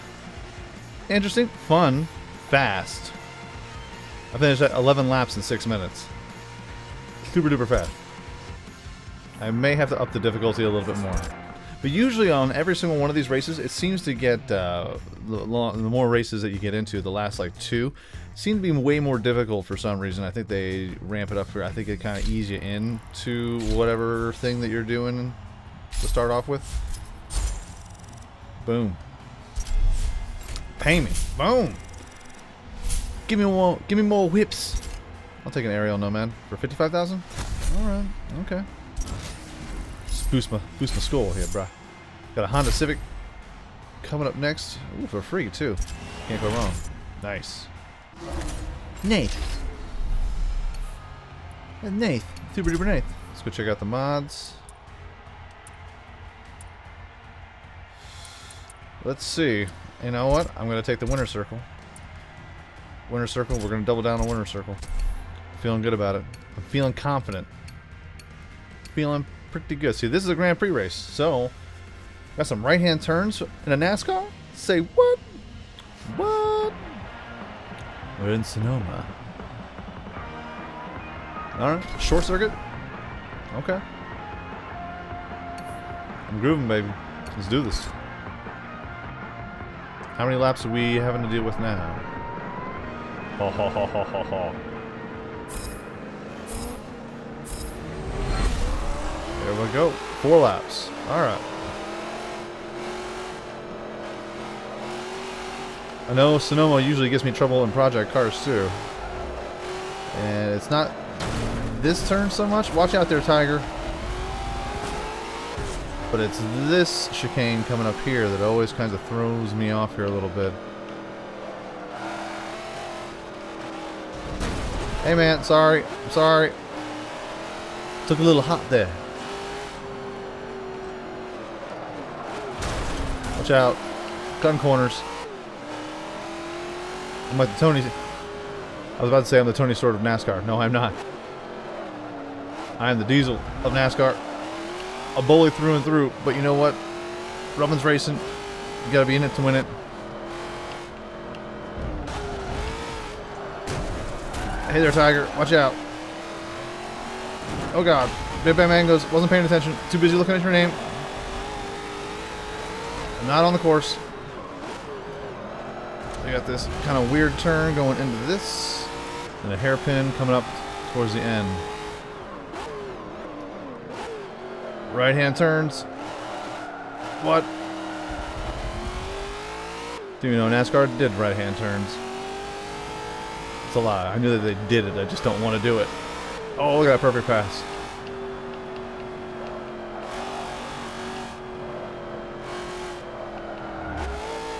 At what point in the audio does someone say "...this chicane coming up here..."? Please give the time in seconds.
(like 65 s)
116 s.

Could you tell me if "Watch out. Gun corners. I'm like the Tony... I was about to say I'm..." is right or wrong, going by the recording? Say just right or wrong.
right.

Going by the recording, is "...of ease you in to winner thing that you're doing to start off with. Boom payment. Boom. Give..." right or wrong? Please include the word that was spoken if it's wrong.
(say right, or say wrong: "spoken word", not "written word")
wrong: "whatever", not "winner".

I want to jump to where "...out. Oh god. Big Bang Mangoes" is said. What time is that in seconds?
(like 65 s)
155 s.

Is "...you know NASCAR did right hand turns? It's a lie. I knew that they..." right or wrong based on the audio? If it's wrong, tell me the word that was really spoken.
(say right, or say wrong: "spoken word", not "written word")
right.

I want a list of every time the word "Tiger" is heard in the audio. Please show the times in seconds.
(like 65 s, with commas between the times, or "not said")
113 s, 154 s.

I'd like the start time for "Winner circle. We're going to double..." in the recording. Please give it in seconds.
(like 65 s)
63 s.